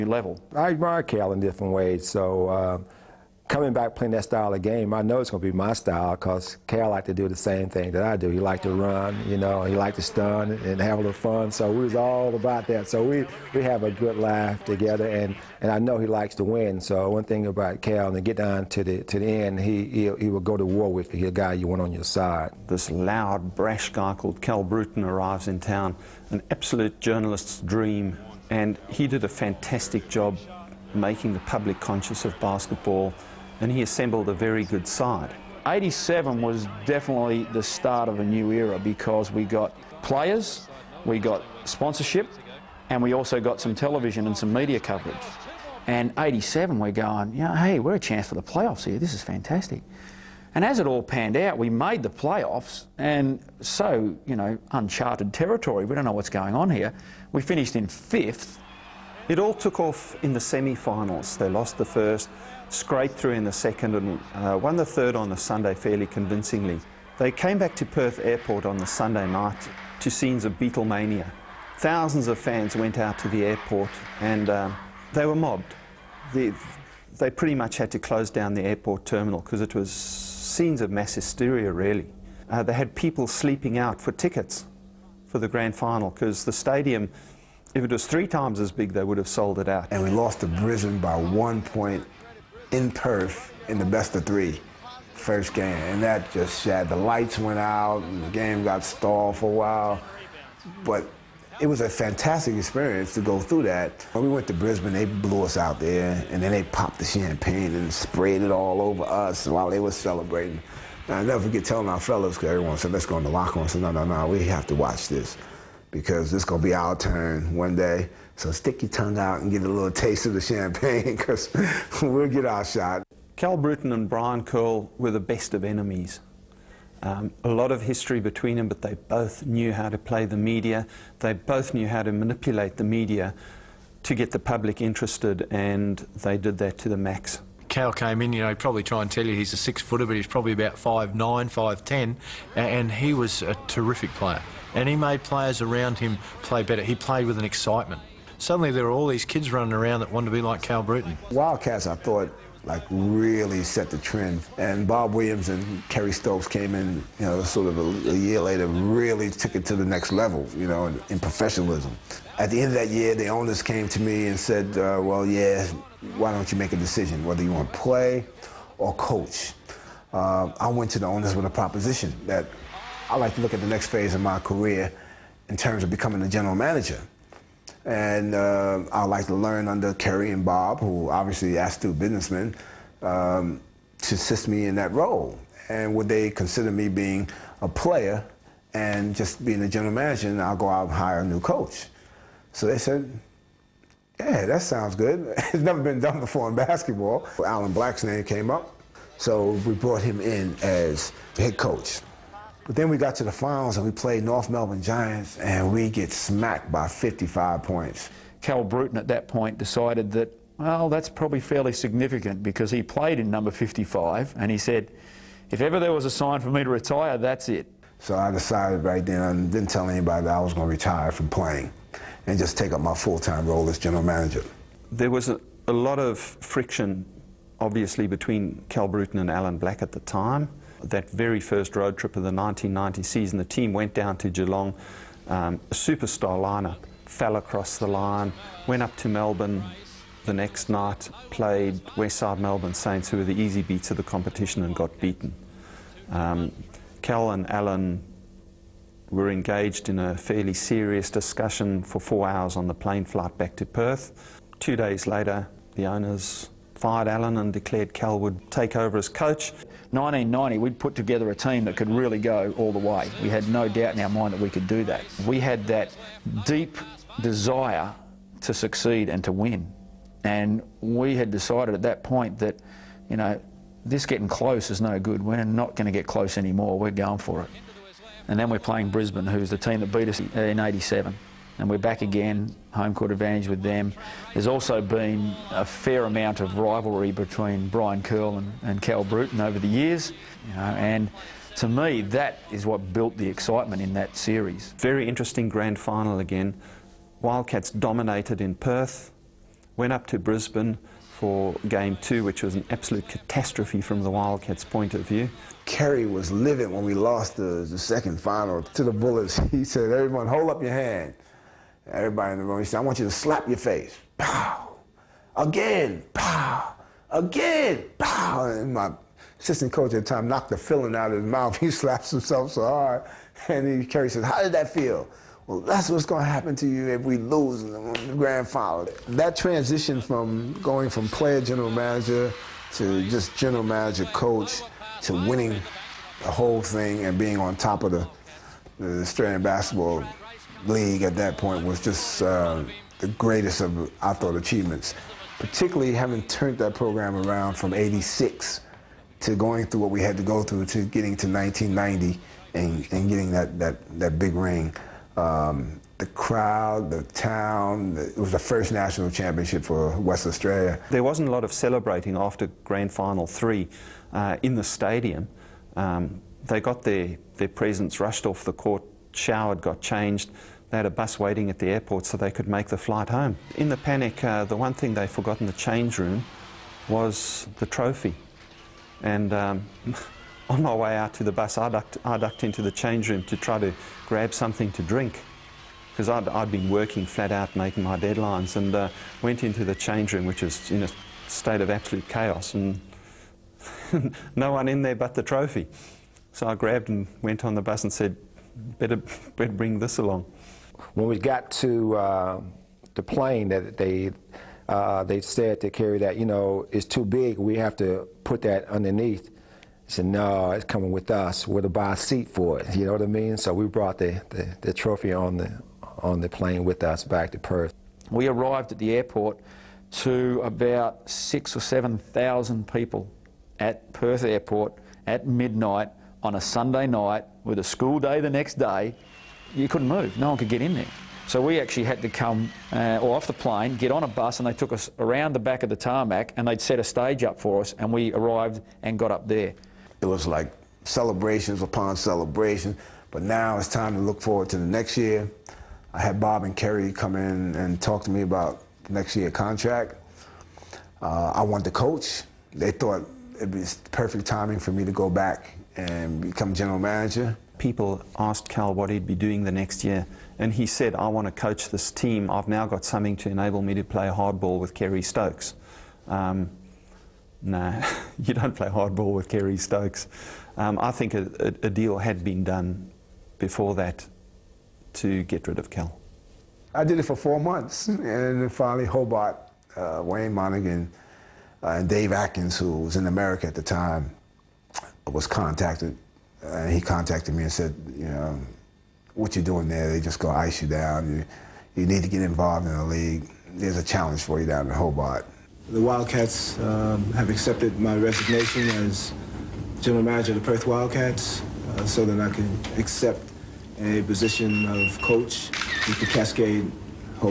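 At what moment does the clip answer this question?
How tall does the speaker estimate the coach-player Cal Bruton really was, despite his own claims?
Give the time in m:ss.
2:20.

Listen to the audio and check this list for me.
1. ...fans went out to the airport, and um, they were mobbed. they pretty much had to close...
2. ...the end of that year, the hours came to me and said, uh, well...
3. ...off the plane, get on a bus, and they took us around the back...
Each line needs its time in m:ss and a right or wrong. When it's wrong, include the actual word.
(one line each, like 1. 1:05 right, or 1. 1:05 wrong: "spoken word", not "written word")
1. 1:12 right
2. 2:42 wrong: "owners", not "hours"
3. 7:13 right.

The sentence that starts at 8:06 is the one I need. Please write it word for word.
Uh, he contacted me and said, you know, what you doing there?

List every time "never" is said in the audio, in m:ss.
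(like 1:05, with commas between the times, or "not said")
1:51, 3:15.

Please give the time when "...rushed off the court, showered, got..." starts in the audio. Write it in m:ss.
6:07.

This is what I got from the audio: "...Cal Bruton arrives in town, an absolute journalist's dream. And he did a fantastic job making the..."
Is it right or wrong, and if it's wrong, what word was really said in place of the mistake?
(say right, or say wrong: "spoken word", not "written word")
right.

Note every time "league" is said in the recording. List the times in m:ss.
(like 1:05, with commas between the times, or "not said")
5:40, 8:12.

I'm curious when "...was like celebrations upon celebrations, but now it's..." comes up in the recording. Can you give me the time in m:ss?
7:20.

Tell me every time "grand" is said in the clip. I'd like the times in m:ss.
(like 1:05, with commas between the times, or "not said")
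1:25, 4:55, 5:28, 6:02.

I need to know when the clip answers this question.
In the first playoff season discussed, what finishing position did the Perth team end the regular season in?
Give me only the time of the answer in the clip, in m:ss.
0:57.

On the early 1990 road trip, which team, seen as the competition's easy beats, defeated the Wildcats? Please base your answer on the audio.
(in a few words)
Westside Melbourne Saints.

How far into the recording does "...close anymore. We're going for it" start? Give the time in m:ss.
4:36.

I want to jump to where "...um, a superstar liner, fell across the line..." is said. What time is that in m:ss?
3:55.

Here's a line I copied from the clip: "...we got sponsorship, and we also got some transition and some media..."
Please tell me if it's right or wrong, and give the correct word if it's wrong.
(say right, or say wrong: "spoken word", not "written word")
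wrong: "television", not "transition".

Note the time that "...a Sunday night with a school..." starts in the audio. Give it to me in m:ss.
7:06.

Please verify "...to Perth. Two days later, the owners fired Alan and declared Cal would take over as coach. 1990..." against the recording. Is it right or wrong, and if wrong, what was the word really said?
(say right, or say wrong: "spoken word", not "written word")
right.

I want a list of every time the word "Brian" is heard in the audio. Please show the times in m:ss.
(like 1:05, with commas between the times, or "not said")
2:04, 4:47.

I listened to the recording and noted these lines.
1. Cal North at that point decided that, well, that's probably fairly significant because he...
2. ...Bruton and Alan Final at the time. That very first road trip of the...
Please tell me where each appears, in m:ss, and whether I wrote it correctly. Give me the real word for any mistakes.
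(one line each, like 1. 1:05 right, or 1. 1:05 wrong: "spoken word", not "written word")
1. 3:28 wrong: "Bruton", not "North"
2. 3:48 wrong: "Black", not "Final".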